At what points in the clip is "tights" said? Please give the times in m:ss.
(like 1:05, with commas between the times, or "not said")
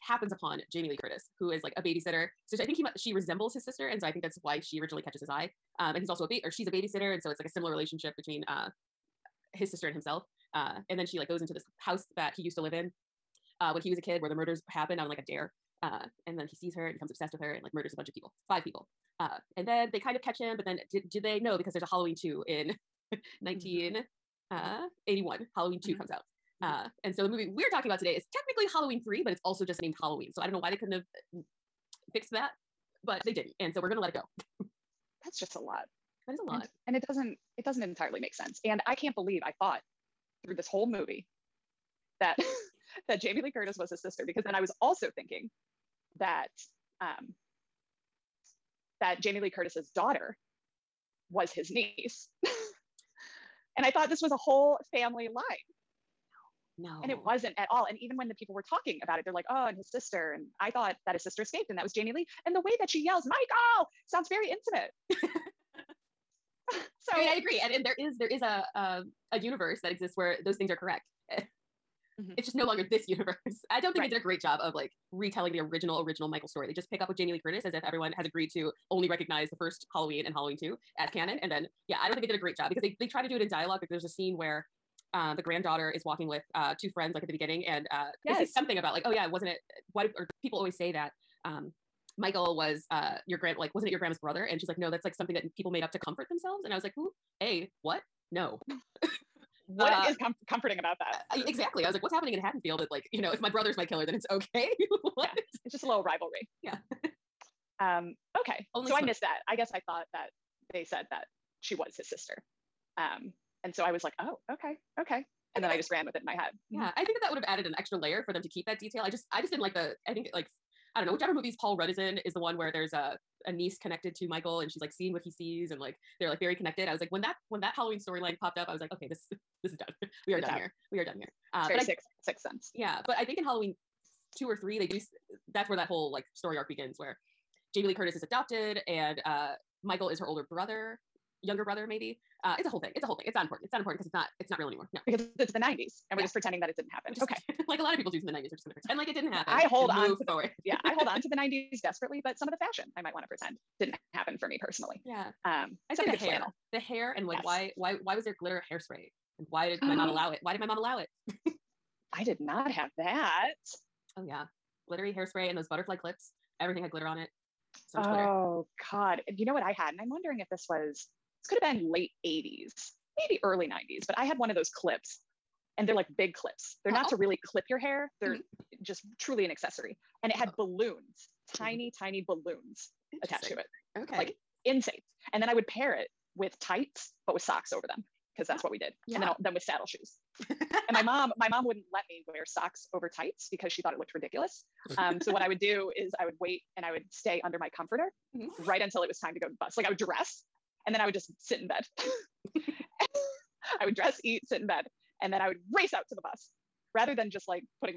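3:06, 3:13.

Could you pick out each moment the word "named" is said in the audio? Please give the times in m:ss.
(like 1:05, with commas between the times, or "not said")
0:29.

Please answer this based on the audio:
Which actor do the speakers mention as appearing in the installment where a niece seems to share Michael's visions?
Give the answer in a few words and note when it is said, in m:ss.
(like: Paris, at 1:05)
Paul Rudd, at 2:01.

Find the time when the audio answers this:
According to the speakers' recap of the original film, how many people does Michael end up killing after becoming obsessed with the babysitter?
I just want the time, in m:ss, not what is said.
0:18.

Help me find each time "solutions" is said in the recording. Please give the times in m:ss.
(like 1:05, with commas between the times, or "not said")
not said.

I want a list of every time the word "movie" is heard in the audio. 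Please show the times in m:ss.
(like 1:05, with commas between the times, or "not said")
0:27, 0:40, 2:01.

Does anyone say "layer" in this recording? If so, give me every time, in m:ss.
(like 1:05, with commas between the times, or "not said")
1:57.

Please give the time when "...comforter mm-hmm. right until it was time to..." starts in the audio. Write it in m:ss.
3:17.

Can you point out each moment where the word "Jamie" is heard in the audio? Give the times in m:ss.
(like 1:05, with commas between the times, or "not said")
0:00, 0:43, 0:49, 1:01, 1:17, 2:17.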